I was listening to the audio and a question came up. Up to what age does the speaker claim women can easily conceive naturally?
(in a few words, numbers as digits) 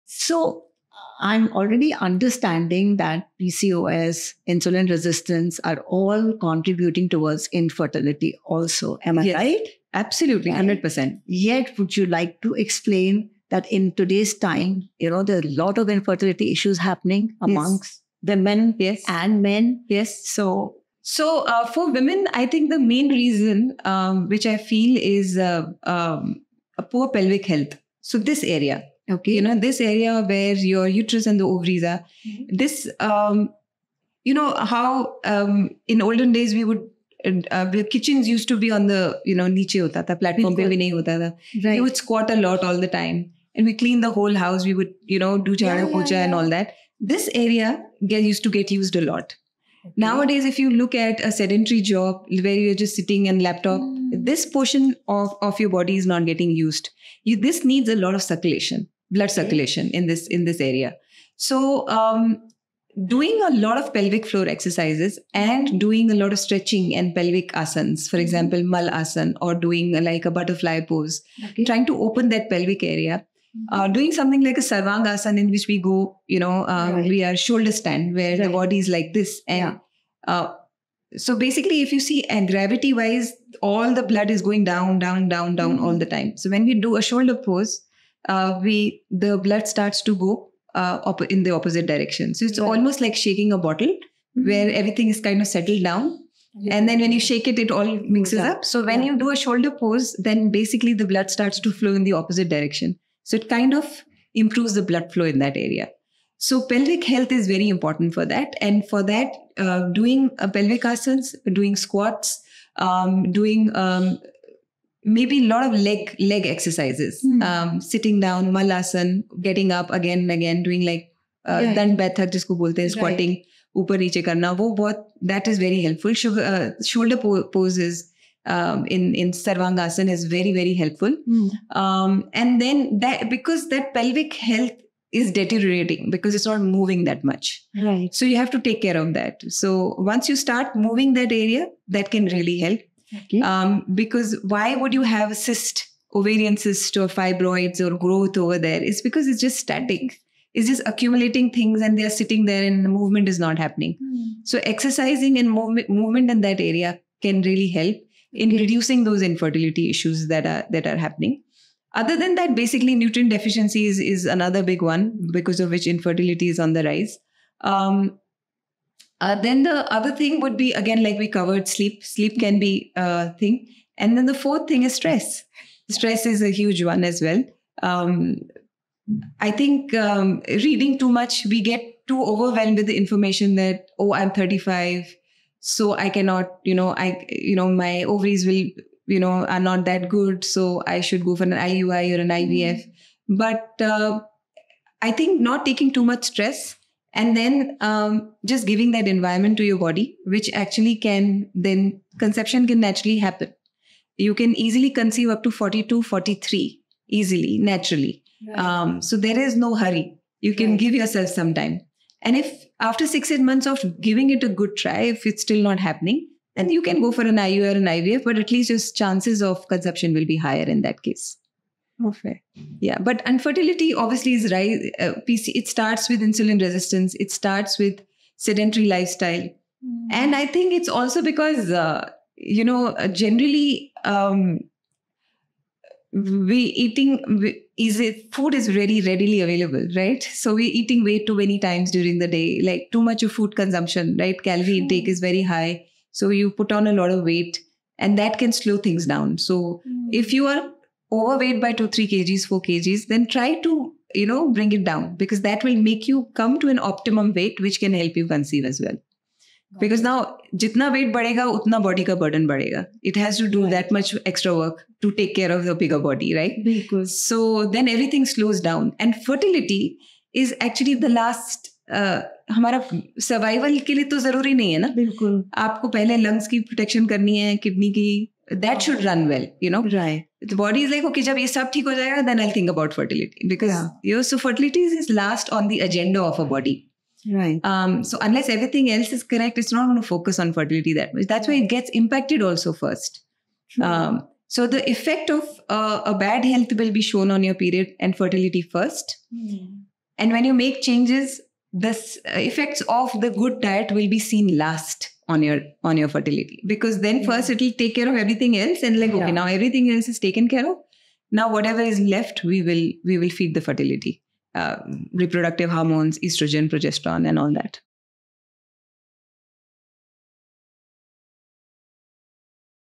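42 to 43.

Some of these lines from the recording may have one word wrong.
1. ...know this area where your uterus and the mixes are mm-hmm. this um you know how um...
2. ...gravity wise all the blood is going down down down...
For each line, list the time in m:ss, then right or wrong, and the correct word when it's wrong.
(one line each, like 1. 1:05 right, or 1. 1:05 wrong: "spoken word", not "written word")
1. 0:29 wrong: "ovaries", not "mixes"
2. 1:22 right.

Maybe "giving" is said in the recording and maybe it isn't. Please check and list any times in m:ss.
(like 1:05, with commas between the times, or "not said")
3:18, 3:34.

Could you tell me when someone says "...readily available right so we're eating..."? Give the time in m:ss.
3:59.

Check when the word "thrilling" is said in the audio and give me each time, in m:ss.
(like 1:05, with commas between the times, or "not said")
not said.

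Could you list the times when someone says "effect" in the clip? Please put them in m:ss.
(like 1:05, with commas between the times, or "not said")
4:54, 5:02.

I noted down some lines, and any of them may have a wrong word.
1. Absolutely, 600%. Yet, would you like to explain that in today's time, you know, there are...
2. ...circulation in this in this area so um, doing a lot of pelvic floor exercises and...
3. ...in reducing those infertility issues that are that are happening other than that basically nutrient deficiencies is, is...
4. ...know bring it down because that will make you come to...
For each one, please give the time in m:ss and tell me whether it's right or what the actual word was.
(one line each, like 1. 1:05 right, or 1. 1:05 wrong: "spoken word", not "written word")
1. 0:09 wrong: "100", not "600"
2. 0:59 right
3. 2:38 right
4. 4:14 right.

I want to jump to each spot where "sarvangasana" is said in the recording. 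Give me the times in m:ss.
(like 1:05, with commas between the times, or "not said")
1:14, 2:09.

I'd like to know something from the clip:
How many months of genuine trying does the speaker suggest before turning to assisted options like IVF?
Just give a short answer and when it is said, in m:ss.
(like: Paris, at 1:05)
6 to 8 months, at 3:33.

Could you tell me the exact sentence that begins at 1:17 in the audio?
we are shoulder stand where right.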